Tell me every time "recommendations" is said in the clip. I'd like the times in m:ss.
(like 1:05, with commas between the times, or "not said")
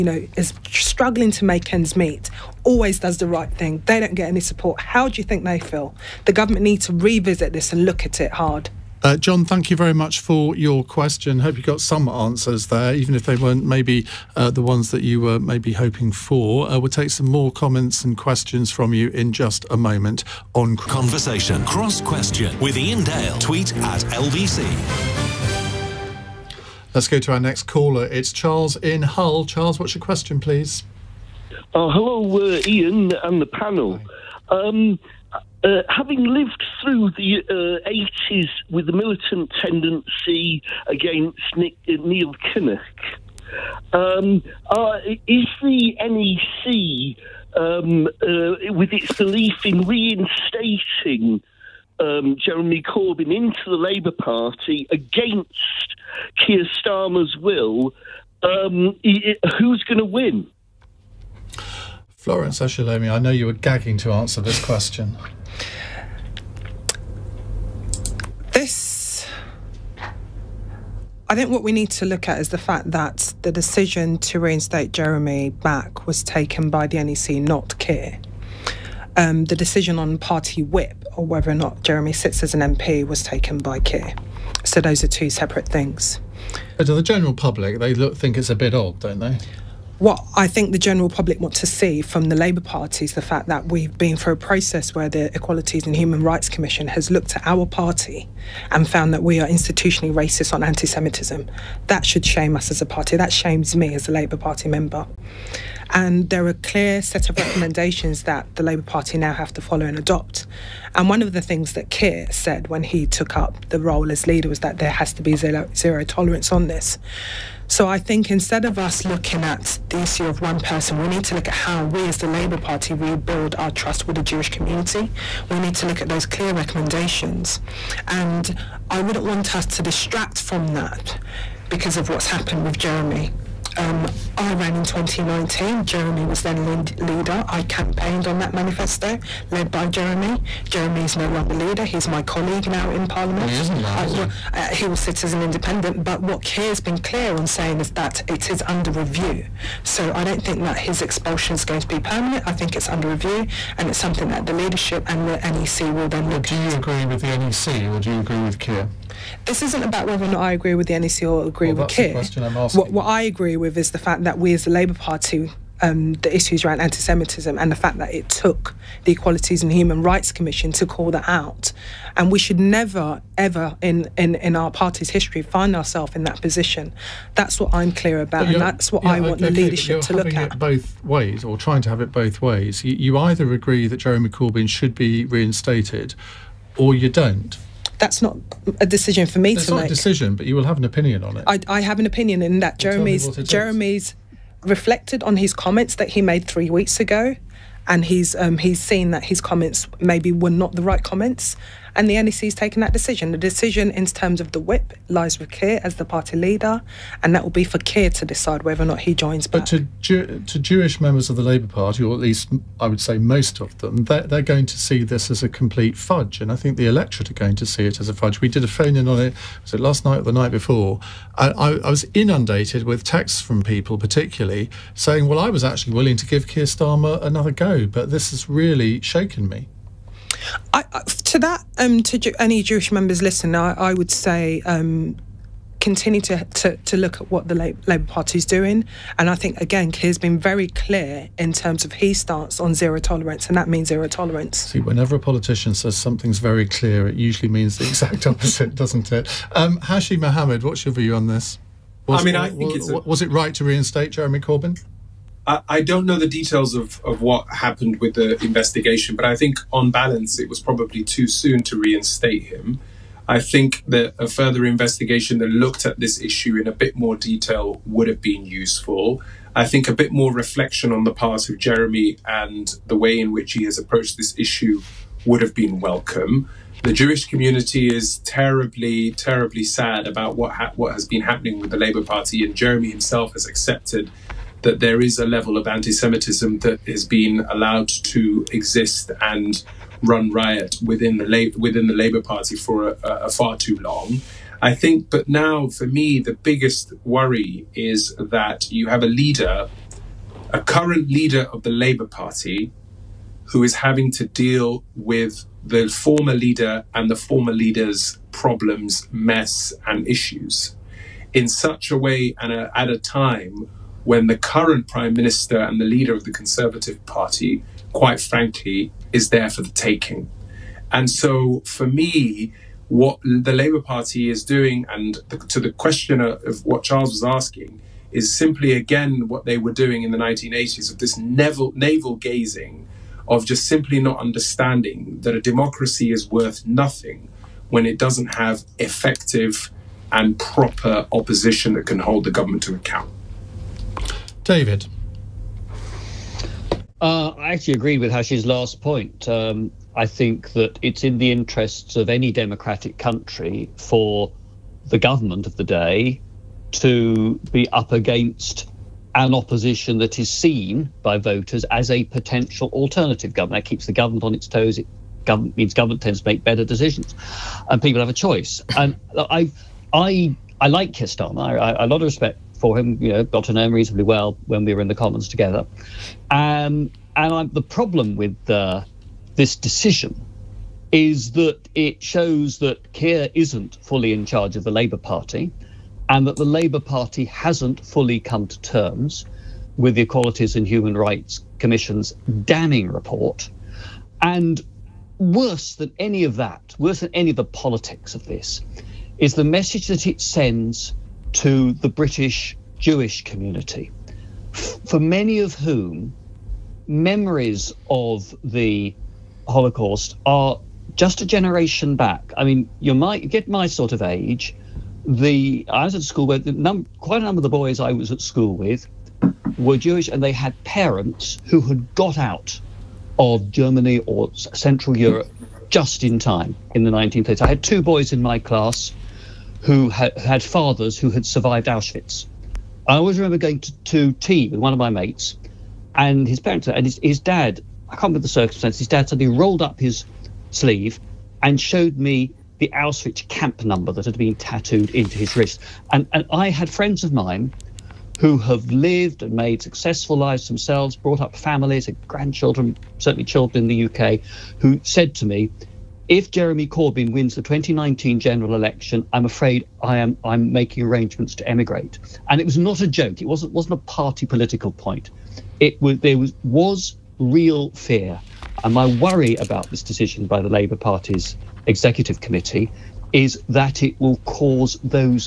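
1:47, 2:06.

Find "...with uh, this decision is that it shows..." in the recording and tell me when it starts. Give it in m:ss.
6:18.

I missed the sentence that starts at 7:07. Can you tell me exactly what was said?
I had two boys in my class who ha- had fathers who had survived Auschwitz.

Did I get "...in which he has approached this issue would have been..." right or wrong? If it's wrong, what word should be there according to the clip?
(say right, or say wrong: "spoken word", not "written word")
right.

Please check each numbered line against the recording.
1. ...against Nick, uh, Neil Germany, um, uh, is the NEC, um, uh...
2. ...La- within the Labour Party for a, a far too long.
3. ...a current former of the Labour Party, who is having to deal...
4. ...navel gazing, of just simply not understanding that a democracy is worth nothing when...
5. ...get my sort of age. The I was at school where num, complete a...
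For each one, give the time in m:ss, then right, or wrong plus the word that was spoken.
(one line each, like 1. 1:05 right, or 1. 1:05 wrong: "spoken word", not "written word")
1. 0:40 wrong: "Kinnock", not "Germany"
2. 4:51 right
3. 5:00 wrong: "leader", not "former"
4. 5:31 right
5. 6:53 wrong: "quite", not "complete".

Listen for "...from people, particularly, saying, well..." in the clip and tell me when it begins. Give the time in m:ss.
3:43.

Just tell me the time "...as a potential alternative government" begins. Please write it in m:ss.
6:01.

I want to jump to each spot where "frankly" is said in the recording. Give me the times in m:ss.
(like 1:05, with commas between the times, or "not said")
5:18.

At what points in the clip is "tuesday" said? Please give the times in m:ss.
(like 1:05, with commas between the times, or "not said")
not said.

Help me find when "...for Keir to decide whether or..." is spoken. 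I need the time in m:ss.
3:27.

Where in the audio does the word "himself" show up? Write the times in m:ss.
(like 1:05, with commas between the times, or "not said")
4:42.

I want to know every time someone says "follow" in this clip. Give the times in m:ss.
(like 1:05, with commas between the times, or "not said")
1:49.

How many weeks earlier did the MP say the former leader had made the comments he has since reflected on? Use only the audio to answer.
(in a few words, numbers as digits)
Three.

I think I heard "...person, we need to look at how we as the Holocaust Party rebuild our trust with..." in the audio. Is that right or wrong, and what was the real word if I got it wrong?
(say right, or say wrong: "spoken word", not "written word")
wrong: "Labour", not "Holocaust".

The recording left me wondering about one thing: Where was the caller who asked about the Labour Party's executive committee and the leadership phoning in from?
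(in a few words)
Hull.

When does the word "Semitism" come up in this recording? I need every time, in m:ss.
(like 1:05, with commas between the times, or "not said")
1:40, 2:46, 4:45.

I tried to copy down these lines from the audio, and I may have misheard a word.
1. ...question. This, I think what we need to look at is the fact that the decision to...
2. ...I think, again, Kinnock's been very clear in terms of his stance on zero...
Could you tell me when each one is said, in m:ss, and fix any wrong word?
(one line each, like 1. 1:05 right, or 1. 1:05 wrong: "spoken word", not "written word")
1. 1:04 right
2. 3:59 wrong: "Keir", not "Kinnock".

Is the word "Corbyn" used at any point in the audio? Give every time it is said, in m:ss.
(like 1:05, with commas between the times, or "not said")
0:52, 3:04, 4:14, 7:36.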